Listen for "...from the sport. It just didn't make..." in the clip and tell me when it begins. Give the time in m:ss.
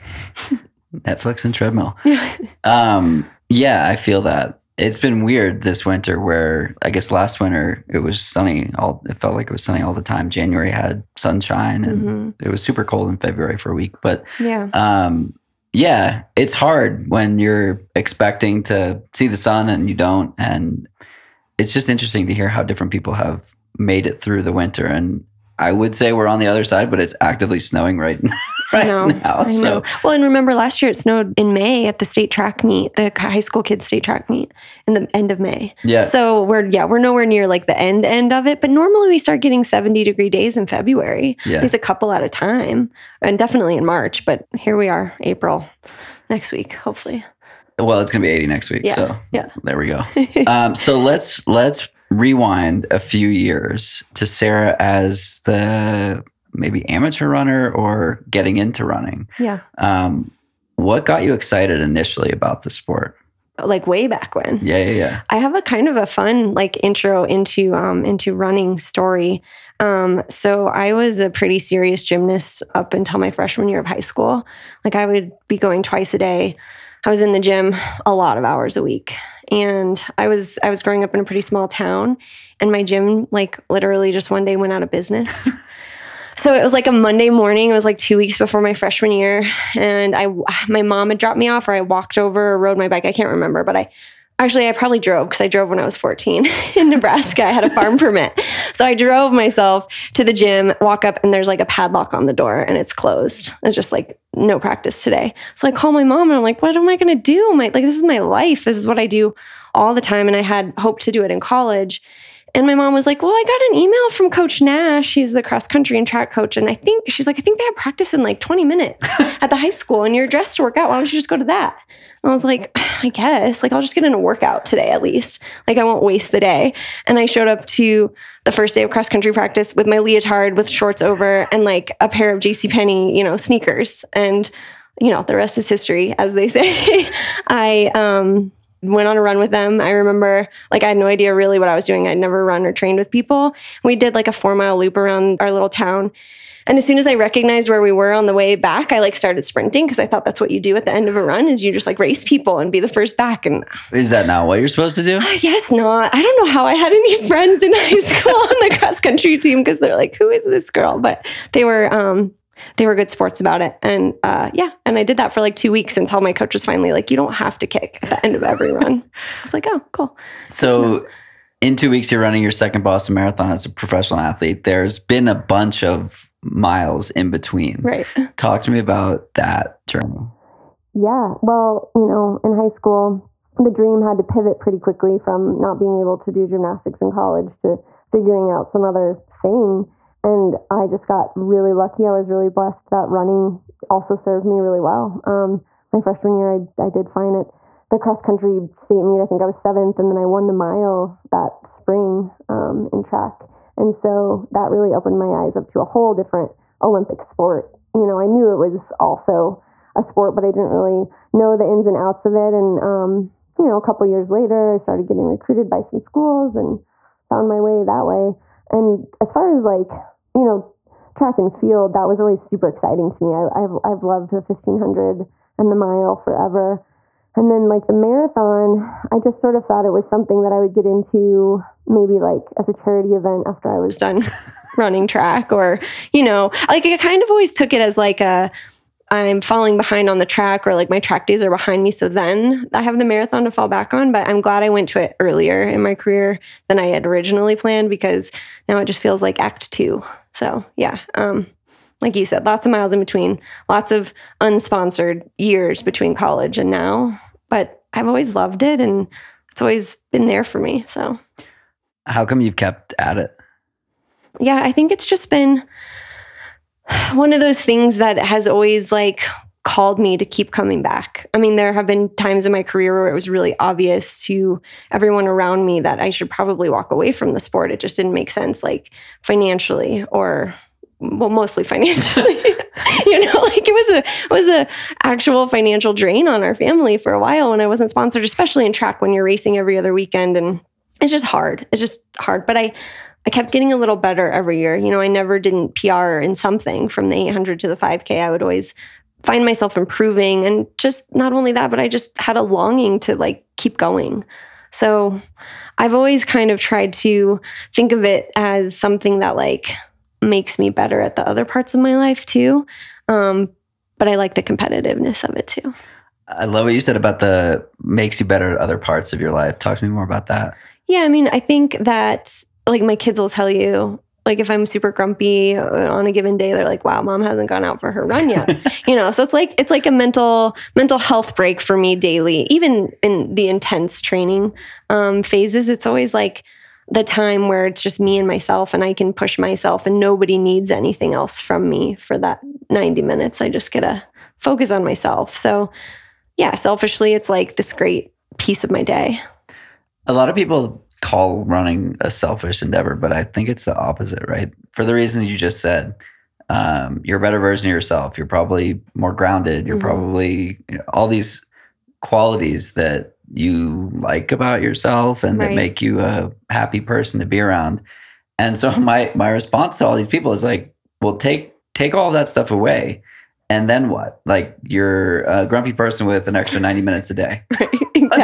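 4:37.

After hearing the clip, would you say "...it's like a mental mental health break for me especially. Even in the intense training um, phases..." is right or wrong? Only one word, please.
wrong.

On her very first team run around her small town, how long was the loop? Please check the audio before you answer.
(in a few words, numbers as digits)
4 miles.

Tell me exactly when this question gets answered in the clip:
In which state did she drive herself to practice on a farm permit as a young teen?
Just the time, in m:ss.
1:36.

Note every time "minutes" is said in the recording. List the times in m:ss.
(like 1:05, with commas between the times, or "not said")
1:58, 5:43, 6:16.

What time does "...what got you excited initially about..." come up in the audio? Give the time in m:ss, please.
1:00.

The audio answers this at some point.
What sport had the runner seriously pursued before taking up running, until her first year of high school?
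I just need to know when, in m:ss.
1:12.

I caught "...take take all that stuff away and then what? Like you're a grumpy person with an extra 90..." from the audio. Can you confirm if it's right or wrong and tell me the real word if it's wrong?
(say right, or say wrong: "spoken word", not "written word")
right.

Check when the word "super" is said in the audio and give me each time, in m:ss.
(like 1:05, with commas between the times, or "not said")
0:12, 3:42, 5:24.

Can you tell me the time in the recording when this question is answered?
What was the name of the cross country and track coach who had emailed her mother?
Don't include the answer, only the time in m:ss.
1:54.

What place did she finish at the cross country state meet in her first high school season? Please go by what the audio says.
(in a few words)
Seventh.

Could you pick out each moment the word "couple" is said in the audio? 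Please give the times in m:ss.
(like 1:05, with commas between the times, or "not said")
0:41, 3:33.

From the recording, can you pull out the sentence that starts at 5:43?
I just get to focus on myself.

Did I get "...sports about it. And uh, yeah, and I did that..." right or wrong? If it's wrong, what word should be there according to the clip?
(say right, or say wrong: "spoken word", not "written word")
right.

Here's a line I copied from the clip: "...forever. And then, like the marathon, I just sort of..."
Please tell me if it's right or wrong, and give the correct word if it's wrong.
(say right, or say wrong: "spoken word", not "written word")
right.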